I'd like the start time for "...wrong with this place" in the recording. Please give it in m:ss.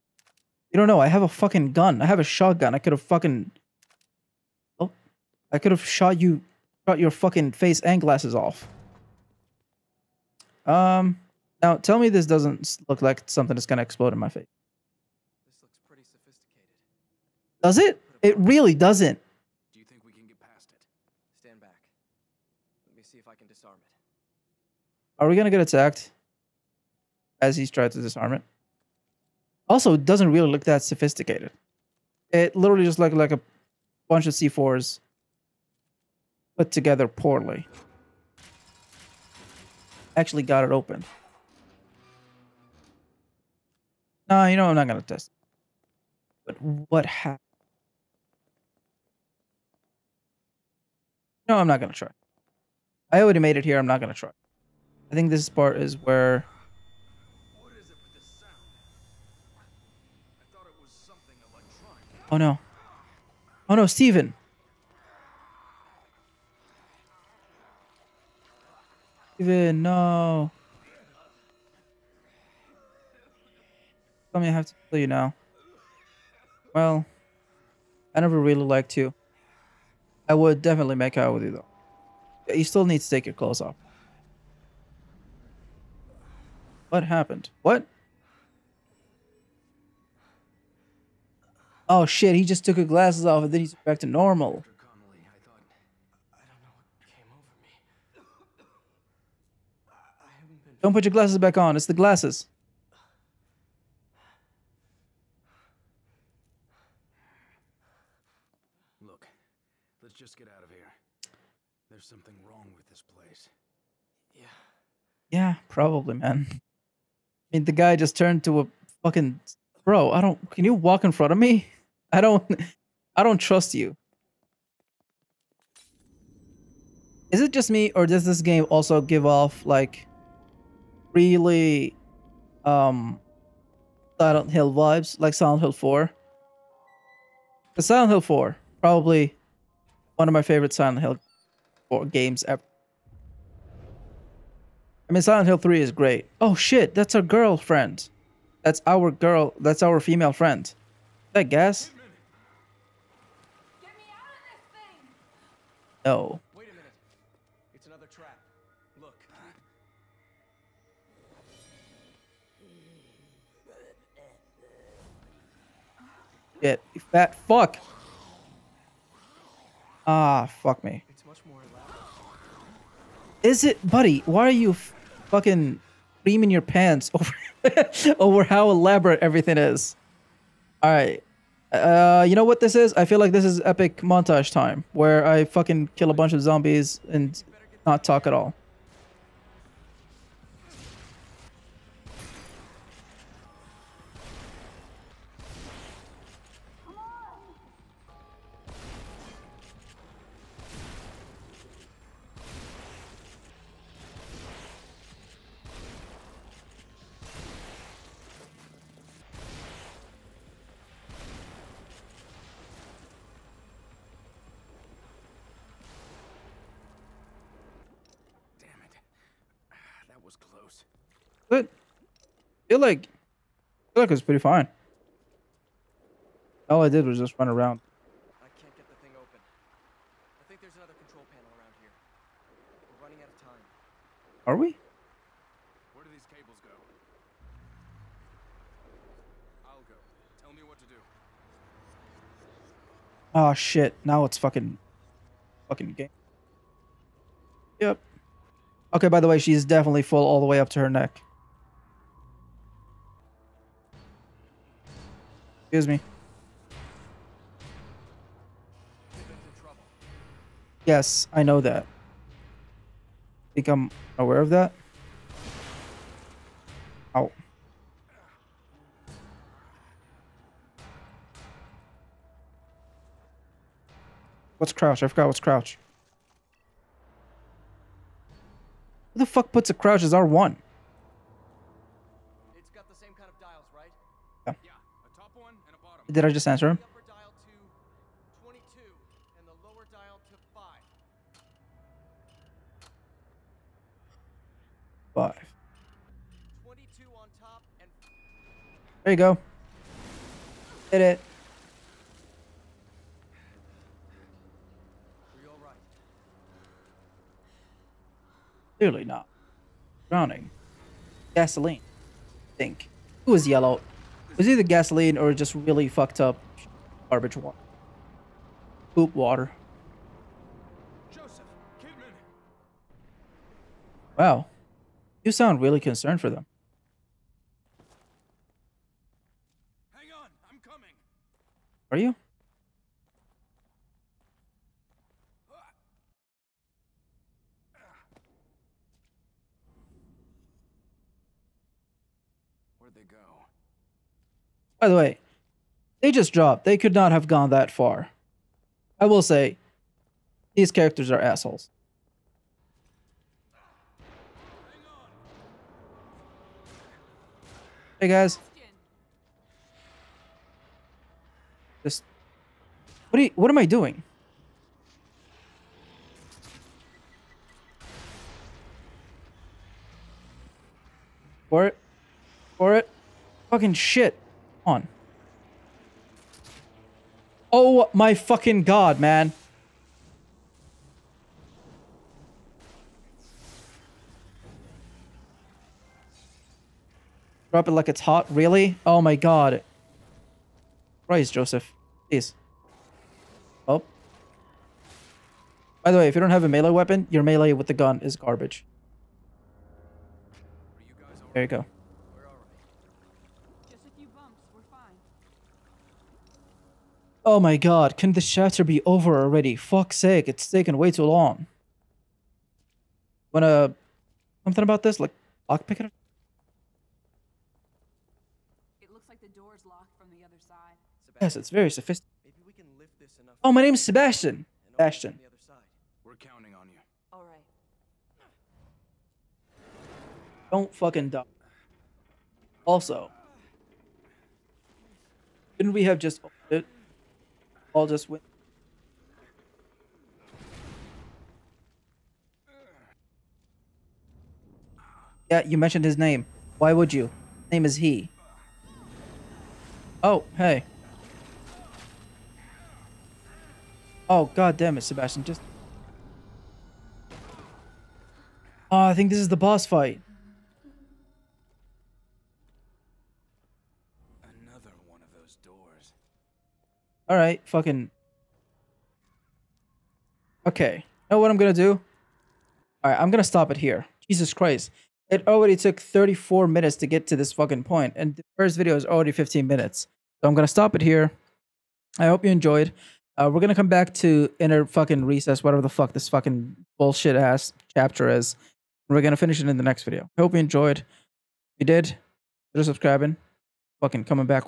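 1:52.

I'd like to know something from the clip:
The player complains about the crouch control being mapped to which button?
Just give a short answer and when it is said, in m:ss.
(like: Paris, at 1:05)
R1, at 4:40.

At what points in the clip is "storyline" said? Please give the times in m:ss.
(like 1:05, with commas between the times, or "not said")
not said.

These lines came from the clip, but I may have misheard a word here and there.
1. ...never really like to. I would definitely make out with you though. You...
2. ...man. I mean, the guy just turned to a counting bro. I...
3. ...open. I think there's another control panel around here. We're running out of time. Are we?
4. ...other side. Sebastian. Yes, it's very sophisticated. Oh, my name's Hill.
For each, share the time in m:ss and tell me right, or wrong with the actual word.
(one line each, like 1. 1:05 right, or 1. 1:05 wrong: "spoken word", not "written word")
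1. 1:18 right
2. 1:56 wrong: "fucking", not "counting"
3. 3:49 right
4. 7:00 wrong: "Sebastian", not "Hill".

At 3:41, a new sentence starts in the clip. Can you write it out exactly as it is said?
But feel like feel like it was pretty fine.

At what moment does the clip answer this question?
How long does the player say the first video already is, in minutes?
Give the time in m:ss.
7:59.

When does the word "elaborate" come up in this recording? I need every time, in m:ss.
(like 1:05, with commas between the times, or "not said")
2:58.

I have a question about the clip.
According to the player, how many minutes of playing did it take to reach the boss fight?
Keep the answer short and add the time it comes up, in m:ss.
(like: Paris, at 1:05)
34, at 7:55.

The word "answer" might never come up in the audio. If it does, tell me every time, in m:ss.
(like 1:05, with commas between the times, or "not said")
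4:46.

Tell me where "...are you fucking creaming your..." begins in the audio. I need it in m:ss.
2:54.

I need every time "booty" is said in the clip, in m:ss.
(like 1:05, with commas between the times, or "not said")
not said.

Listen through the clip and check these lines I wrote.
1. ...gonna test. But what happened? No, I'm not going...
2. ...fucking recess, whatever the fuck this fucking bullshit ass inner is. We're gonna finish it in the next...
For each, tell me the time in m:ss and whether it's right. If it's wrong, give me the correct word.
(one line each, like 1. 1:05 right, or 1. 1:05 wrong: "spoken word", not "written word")
1. 0:44 right
2. 8:04 wrong: "chapter", not "inner".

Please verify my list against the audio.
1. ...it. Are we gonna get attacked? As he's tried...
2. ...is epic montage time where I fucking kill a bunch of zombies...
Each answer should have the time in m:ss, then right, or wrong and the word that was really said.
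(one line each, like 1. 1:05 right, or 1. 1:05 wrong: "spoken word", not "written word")
1. 0:23 right
2. 3:03 right.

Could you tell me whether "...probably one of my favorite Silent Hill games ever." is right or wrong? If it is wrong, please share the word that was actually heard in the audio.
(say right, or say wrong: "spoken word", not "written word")
right.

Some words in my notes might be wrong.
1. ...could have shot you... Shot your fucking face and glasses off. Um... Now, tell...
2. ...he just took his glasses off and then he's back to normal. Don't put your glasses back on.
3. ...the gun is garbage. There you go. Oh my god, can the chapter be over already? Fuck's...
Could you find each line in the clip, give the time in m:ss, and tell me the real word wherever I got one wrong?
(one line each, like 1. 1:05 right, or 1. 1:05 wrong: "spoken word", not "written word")
1. 0:05 right
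2. 1:32 right
3. 6:37 right.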